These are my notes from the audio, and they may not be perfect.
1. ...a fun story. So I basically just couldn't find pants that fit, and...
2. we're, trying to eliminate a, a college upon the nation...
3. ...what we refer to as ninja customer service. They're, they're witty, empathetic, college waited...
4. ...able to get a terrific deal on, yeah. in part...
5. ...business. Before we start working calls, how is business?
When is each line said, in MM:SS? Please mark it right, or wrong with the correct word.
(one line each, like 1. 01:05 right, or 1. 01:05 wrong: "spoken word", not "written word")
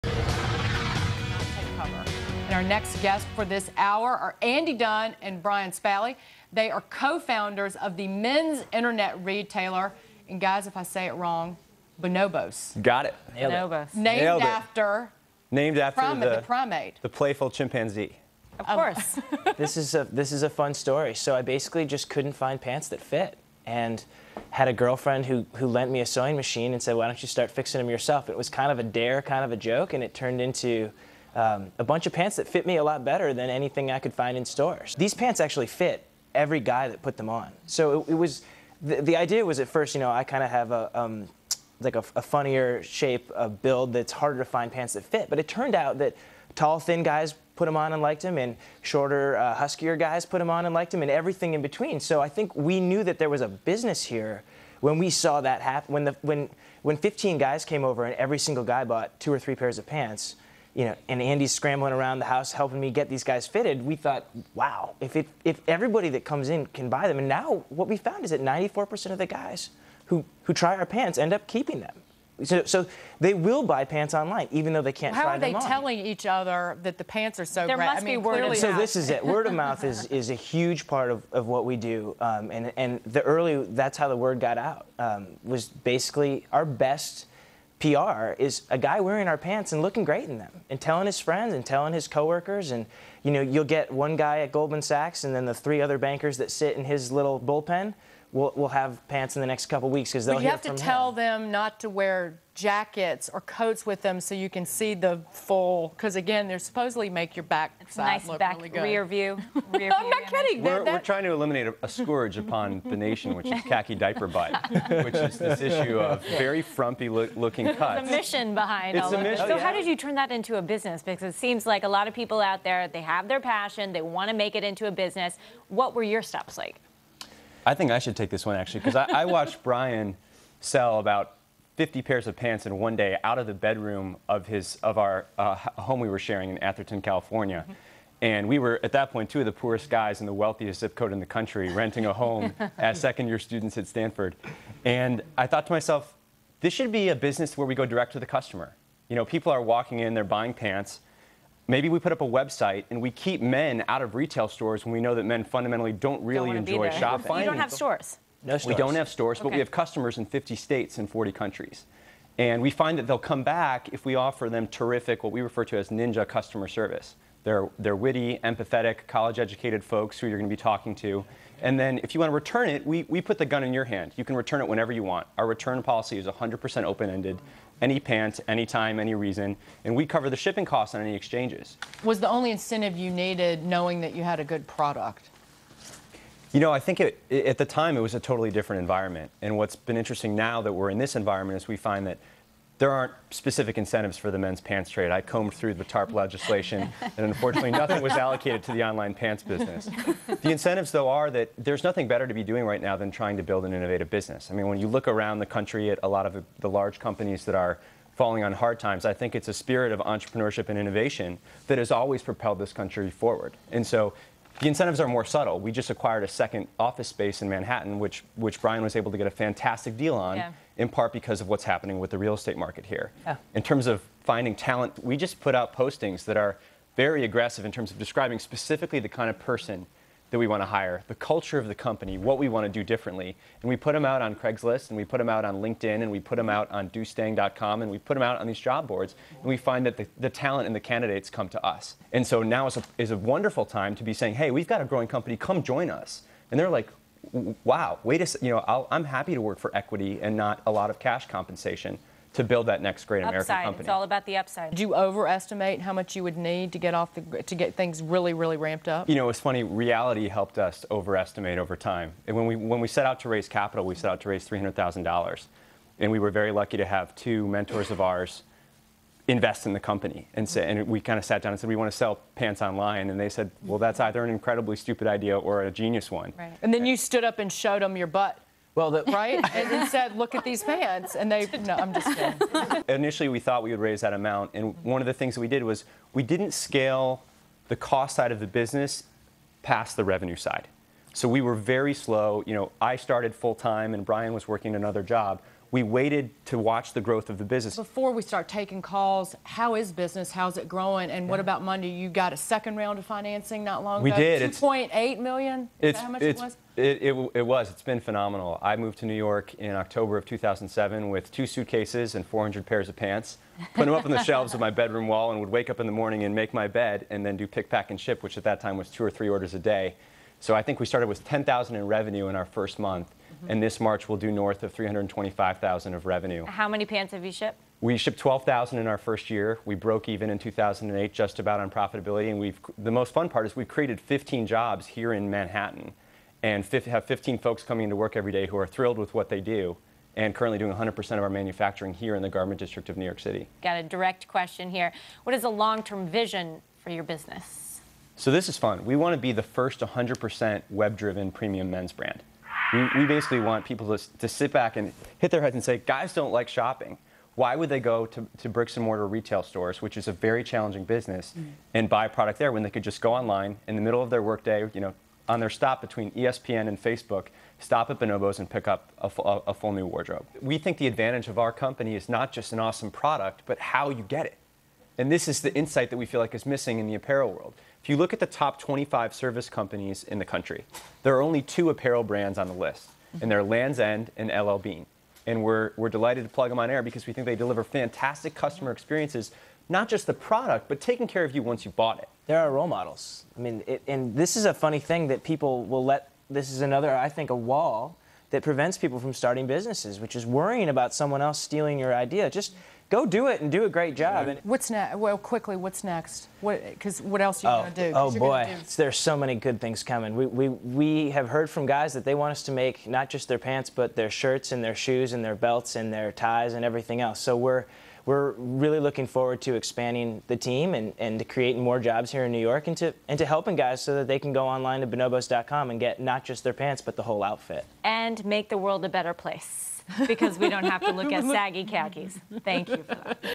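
1. 00:20 right
2. 01:50 wrong: "scourge", not "college"
3. 02:45 wrong: "educated", not "waited"
4. 03:38 wrong: "fantastic", not "terrific"
5. 04:57 wrong: "taking", not "working".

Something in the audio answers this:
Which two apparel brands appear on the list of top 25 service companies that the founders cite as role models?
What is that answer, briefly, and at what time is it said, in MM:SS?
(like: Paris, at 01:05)
Lands' End and LL Bean, at 06:23.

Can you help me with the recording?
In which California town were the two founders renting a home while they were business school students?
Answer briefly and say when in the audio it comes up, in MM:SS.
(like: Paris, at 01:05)
Atherton, at 02:16.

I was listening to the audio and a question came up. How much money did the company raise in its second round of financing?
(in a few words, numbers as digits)
$2.8 million.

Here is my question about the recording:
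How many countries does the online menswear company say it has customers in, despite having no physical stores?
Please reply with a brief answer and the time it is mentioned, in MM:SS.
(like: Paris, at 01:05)
40, at 02:41.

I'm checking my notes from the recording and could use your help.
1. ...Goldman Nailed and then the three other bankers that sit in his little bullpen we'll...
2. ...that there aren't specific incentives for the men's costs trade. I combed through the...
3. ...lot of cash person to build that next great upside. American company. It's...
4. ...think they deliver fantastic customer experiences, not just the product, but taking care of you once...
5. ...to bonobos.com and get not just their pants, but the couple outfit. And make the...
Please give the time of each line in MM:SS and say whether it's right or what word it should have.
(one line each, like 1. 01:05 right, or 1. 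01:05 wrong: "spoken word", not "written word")
1. 01:34 wrong: "Sachs", not "Nailed"
2. 03:12 wrong: "pants", not "costs"
3. 04:10 wrong: "compensation", not "person"
4. 06:27 right
5. 07:04 wrong: "whole", not "couple".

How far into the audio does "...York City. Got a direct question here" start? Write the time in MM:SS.
05:43.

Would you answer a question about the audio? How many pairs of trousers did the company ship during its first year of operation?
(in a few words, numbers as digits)
12,000.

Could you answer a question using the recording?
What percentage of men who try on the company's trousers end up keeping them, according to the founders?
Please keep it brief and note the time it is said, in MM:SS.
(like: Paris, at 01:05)
94%, at 01:08.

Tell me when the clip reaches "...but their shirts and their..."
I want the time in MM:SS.
06:53.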